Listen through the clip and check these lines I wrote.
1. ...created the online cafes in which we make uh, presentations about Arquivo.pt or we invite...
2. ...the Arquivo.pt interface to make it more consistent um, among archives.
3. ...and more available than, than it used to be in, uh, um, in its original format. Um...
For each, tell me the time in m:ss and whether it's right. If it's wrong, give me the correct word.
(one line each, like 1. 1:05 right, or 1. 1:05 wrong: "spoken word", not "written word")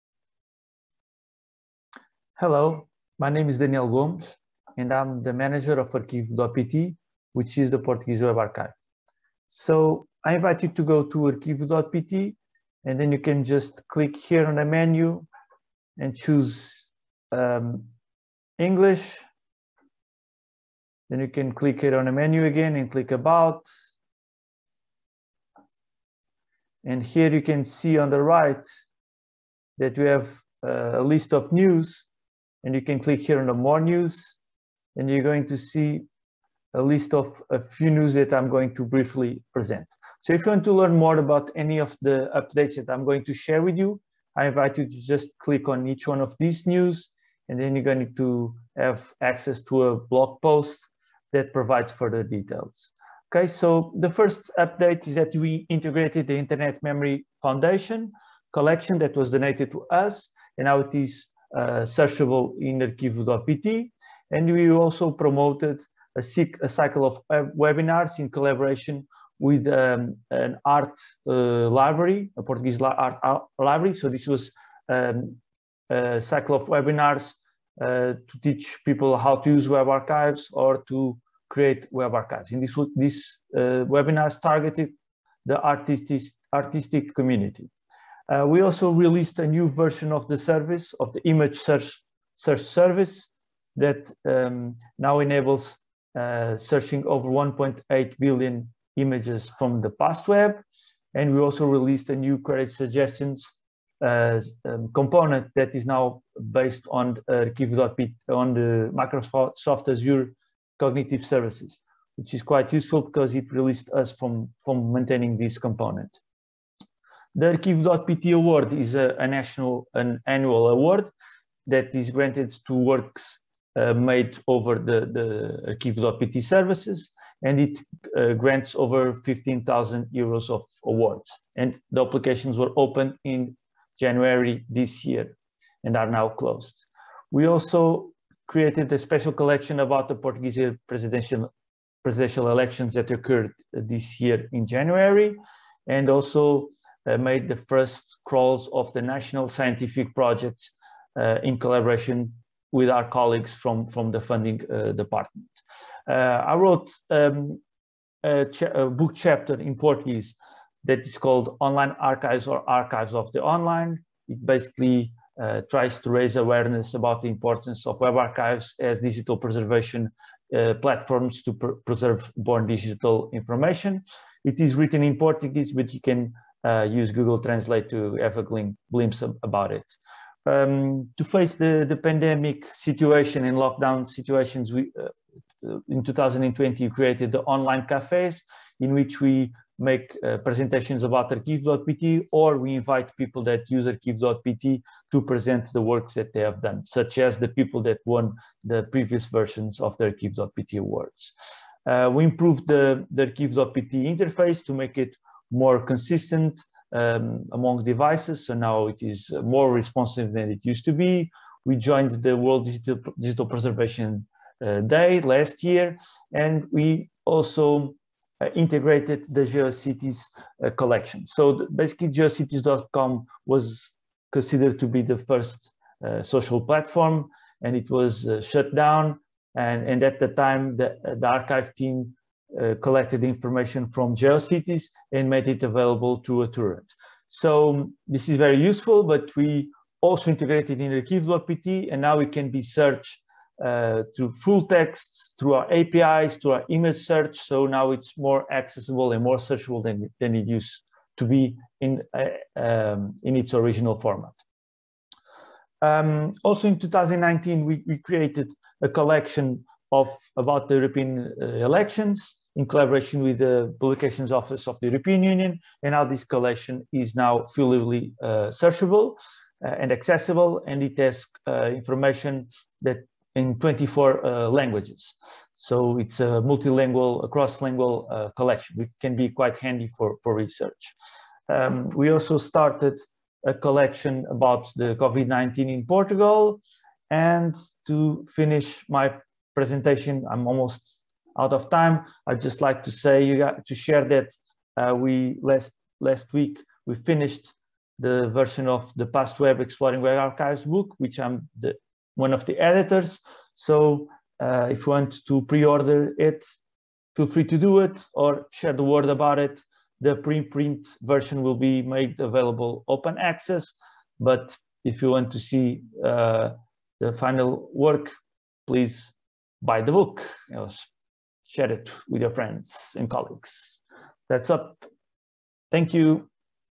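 1. 3:06 right
2. 3:23 wrong: "devices", not "archives"
3. 4:09 wrong: "searchable", not "available".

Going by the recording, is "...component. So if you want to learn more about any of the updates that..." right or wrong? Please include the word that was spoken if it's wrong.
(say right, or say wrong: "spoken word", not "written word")
wrong: "present", not "component".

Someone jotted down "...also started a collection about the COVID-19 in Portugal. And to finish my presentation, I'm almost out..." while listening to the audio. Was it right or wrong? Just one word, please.
right.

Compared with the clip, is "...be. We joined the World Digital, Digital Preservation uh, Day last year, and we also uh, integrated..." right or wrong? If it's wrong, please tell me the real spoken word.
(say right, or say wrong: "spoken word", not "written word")
right.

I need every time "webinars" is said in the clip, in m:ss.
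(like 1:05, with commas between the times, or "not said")
1:07, 1:16, 1:23.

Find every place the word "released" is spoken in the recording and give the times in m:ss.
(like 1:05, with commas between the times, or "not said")
1:28, 1:41, 1:53.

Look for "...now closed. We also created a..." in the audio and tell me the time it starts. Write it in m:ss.
2:16.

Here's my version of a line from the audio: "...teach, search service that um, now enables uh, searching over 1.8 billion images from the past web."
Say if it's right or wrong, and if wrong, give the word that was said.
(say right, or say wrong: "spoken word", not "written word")
wrong: "search", not "teach".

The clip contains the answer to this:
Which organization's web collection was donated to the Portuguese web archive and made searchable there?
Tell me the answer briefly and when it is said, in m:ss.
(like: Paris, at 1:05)
Internet Memory Foundation, at 0:56.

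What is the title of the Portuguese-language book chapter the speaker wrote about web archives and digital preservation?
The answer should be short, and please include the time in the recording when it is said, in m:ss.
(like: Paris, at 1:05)
Online Archives or Archives of the Online, at 2:41.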